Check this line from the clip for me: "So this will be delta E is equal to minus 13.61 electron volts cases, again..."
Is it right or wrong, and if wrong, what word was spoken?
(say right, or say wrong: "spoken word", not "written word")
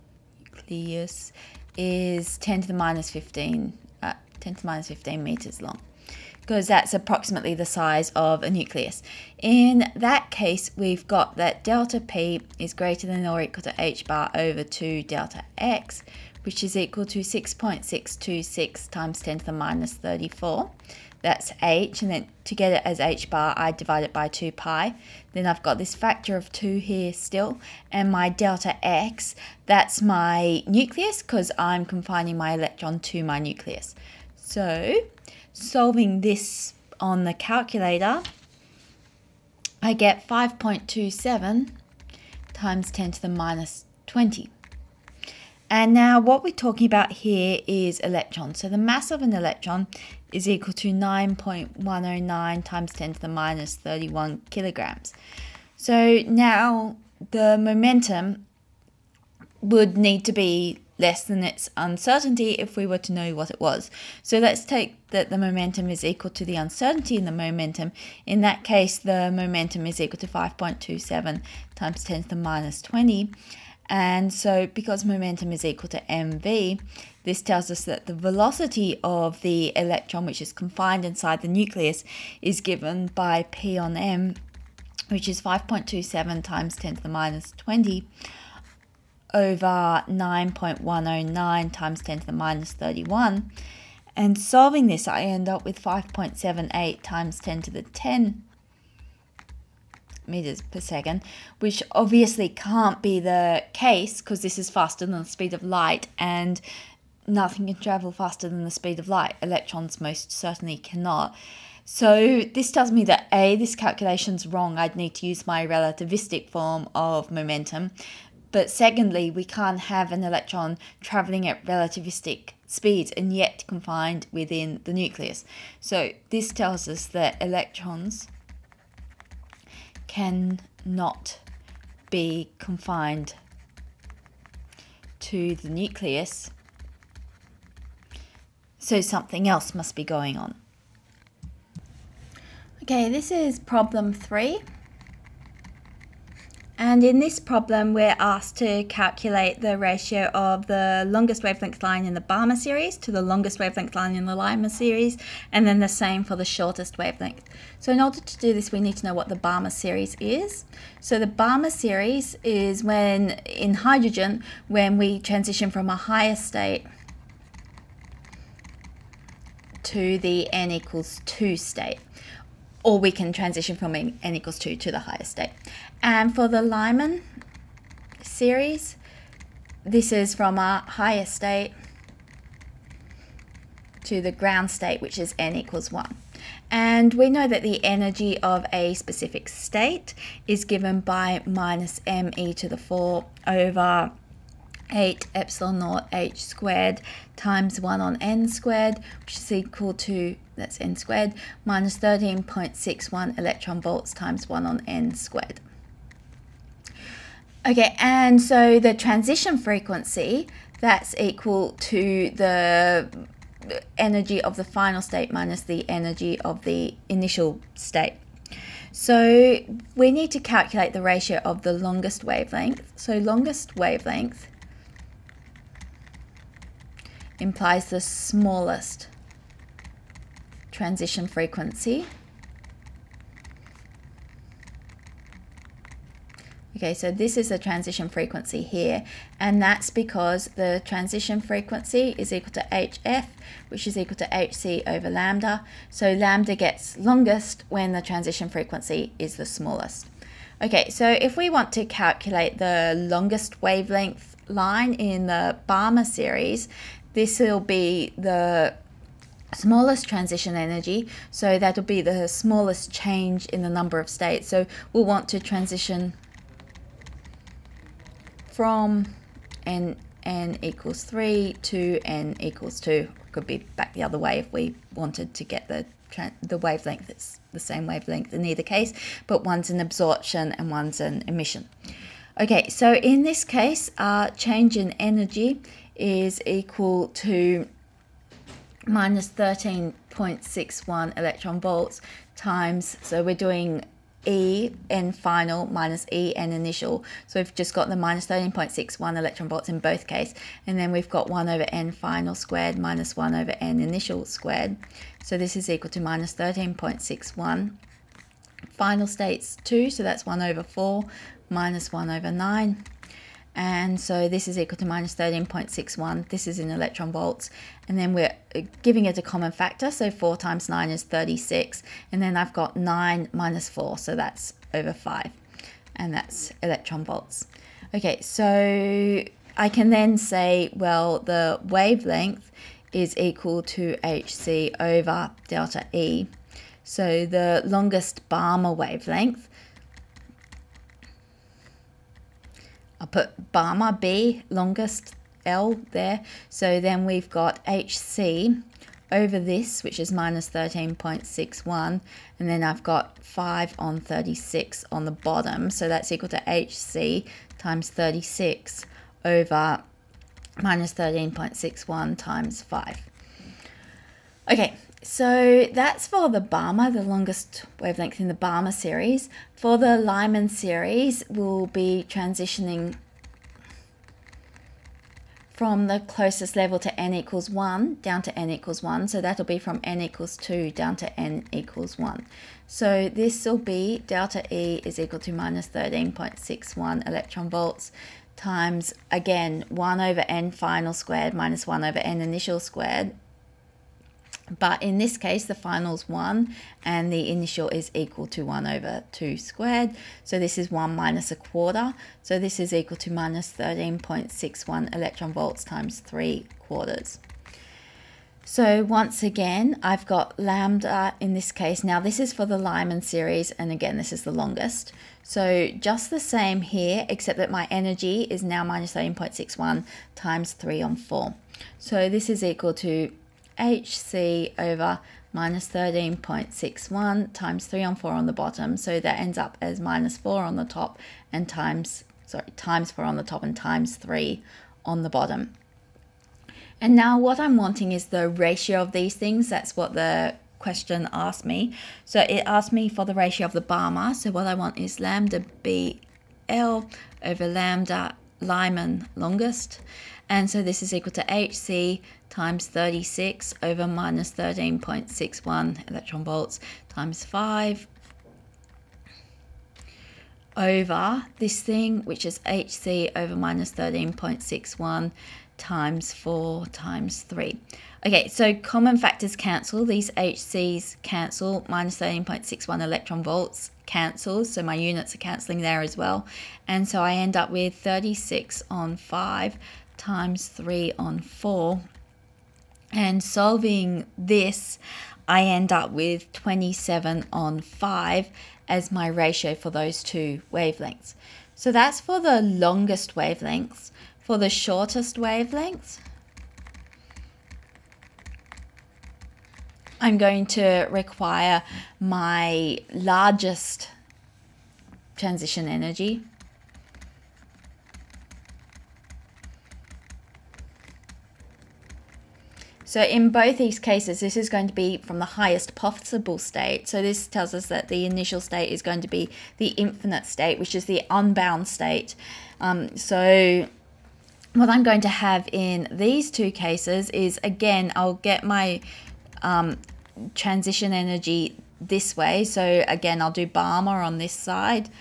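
wrong: "times", not "cases".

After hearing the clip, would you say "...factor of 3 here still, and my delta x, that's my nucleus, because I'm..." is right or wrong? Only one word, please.
wrong.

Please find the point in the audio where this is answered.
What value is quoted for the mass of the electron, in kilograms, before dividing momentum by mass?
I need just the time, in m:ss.
0:50.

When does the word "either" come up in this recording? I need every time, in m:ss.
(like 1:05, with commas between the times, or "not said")
4:38.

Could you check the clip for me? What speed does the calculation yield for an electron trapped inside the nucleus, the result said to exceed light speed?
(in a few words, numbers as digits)
5.78 x 10^10 m/s.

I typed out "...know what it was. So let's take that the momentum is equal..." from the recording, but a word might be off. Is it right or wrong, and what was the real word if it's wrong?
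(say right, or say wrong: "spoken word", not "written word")
right.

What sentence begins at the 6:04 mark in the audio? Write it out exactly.
Okay, so that's for the Balmer, the longest wavelength in the Balmer series.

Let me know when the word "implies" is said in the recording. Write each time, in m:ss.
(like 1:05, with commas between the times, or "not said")
3:47.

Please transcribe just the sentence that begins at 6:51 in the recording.
Now this is for the Lyman series, and again, this is the longest.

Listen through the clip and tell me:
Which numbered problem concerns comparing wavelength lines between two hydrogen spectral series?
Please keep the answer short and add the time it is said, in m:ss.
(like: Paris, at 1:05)
3, at 2:23.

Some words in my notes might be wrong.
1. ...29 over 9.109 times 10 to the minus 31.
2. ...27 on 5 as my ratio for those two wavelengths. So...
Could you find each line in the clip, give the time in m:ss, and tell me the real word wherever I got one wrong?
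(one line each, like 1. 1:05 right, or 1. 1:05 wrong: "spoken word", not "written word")
1. 1:27 wrong: "20", not "29"
2. 8:06 right.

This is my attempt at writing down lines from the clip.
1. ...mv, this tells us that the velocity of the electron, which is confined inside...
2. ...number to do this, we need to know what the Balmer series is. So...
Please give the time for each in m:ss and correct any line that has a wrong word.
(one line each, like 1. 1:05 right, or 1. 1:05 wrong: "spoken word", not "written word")
1. 1:16 right
2. 2:37 wrong: "order", not "number".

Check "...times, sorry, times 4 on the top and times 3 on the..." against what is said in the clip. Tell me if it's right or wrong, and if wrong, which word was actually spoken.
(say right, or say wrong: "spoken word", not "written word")
right.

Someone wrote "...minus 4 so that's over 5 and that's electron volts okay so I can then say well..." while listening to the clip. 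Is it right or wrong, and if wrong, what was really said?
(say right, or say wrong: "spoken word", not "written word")
right.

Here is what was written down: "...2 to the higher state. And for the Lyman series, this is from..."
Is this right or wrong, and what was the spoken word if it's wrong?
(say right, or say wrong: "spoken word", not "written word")
right.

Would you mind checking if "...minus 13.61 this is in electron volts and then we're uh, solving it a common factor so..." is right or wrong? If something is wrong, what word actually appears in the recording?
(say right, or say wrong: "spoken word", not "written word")
wrong: "giving", not "solving".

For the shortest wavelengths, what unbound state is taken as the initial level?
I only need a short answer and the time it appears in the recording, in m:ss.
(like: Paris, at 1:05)
infinite state, at 8:39.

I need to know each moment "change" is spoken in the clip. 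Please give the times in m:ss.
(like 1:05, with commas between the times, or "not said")
4:22, 4:44.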